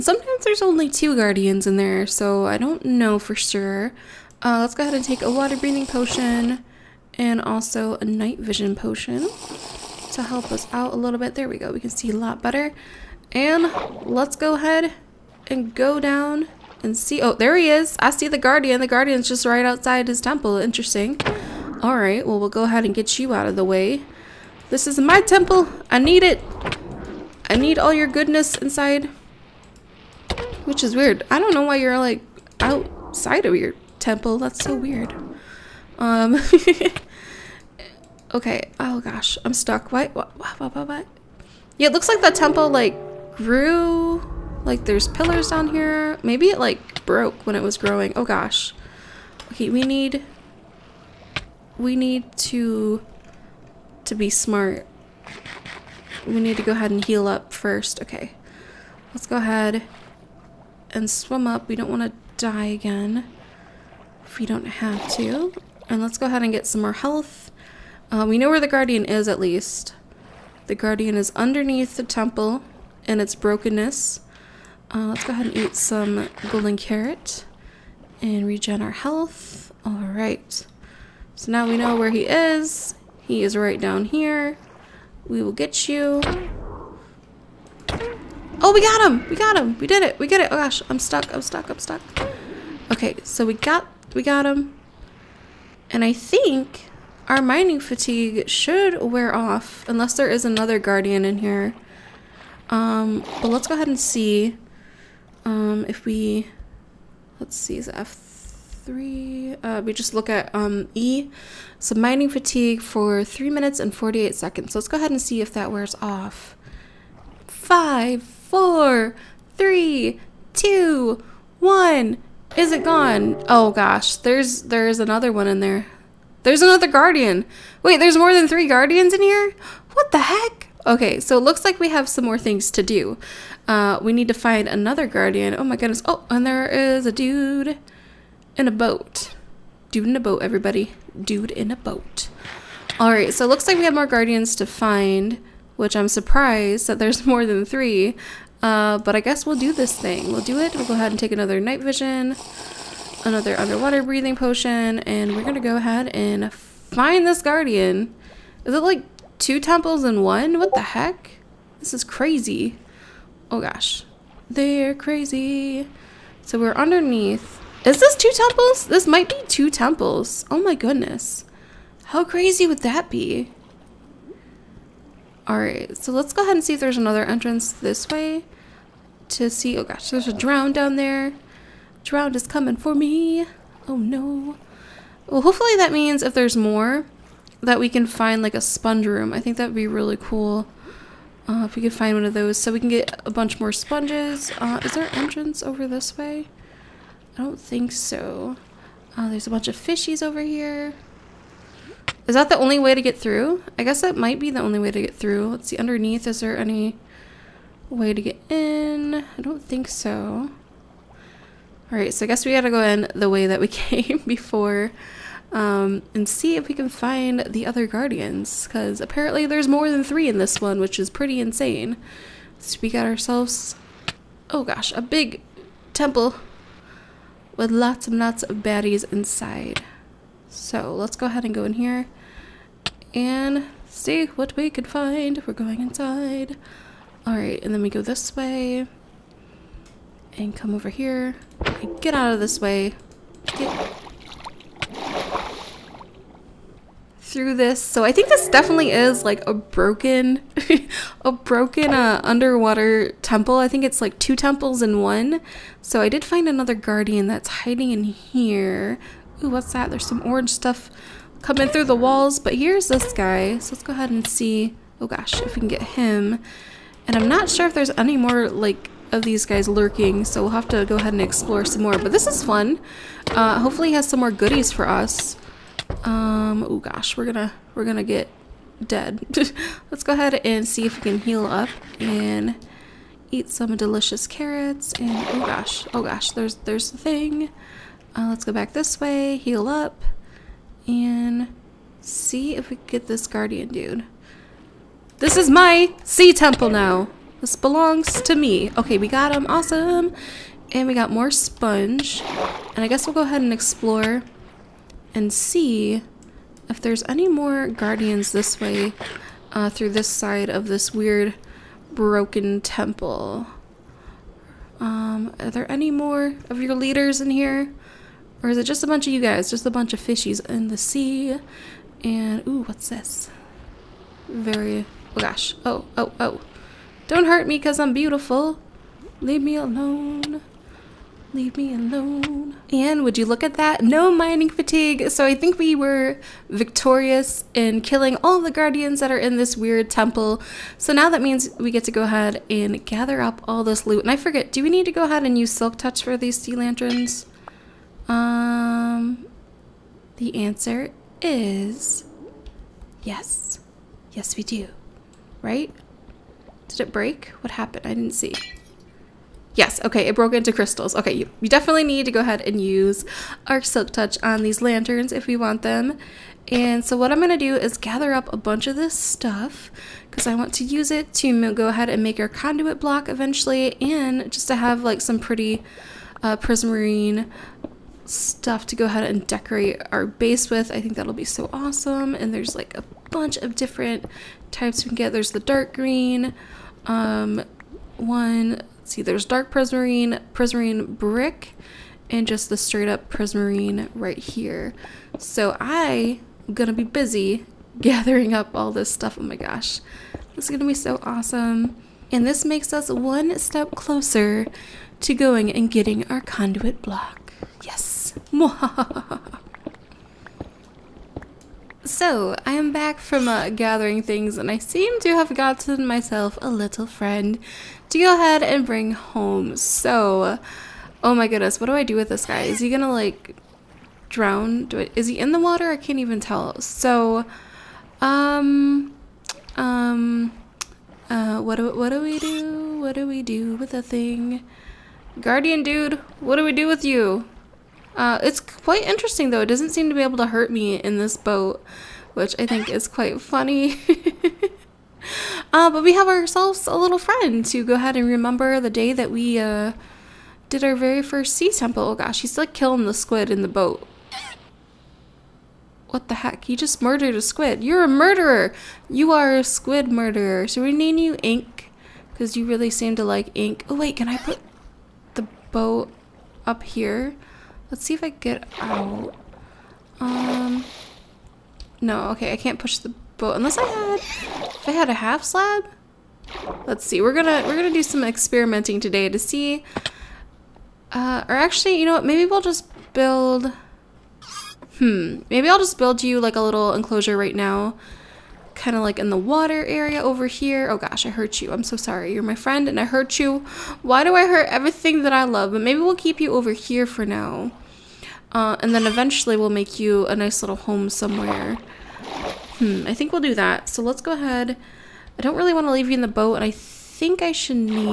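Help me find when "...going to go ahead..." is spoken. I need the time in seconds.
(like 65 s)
155 s.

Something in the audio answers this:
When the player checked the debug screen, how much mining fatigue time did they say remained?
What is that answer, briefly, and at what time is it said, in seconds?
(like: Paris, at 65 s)
3 minutes and 48 seconds, at 113 s.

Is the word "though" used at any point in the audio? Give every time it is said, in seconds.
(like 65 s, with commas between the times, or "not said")
439 s.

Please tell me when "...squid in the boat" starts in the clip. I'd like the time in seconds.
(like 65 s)
452 s.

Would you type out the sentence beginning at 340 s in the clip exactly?
So now that means we get to go ahead and gather up all this loot.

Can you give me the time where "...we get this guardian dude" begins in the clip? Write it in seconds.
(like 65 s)
292 s.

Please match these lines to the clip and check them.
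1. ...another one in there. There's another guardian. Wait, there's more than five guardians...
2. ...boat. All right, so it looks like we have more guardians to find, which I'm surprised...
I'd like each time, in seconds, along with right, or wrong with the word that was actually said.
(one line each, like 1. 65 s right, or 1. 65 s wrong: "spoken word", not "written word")
1. 125 s wrong: "three", not "five"
2. 141 s right.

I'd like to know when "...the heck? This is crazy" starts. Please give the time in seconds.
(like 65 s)
160 s.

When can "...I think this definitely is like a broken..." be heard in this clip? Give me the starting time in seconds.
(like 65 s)
248 s.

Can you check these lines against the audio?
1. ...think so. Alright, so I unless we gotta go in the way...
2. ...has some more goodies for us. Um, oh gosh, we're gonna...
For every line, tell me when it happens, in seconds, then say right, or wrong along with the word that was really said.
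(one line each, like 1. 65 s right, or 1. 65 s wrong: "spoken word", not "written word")
1. 209 s wrong: "guess", not "unless"
2. 273 s right.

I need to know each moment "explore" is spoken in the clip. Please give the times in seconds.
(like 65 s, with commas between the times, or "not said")
271 s, 303 s.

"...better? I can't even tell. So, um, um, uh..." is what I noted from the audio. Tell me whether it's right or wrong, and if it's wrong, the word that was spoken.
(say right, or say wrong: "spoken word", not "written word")
wrong: "water", not "better".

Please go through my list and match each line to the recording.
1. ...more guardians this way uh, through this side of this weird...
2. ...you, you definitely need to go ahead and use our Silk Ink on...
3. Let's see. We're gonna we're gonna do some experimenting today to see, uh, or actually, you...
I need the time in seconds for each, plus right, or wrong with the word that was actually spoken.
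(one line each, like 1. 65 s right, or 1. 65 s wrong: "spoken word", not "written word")
1. 307 s right
2. 361 s wrong: "Touch", not "Ink"
3. 476 s right.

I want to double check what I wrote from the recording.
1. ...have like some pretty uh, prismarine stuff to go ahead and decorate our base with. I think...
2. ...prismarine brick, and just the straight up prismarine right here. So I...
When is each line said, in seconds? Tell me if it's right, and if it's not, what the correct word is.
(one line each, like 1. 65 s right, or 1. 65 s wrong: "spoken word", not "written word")
1. 374 s right
2. 390 s right.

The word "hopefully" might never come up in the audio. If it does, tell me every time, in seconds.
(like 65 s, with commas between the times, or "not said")
185 s, 273 s.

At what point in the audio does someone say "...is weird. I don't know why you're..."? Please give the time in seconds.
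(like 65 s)
30 s.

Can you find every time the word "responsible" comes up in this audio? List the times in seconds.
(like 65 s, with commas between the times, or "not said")
not said.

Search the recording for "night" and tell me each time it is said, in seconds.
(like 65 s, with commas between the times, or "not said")
8 s, 151 s.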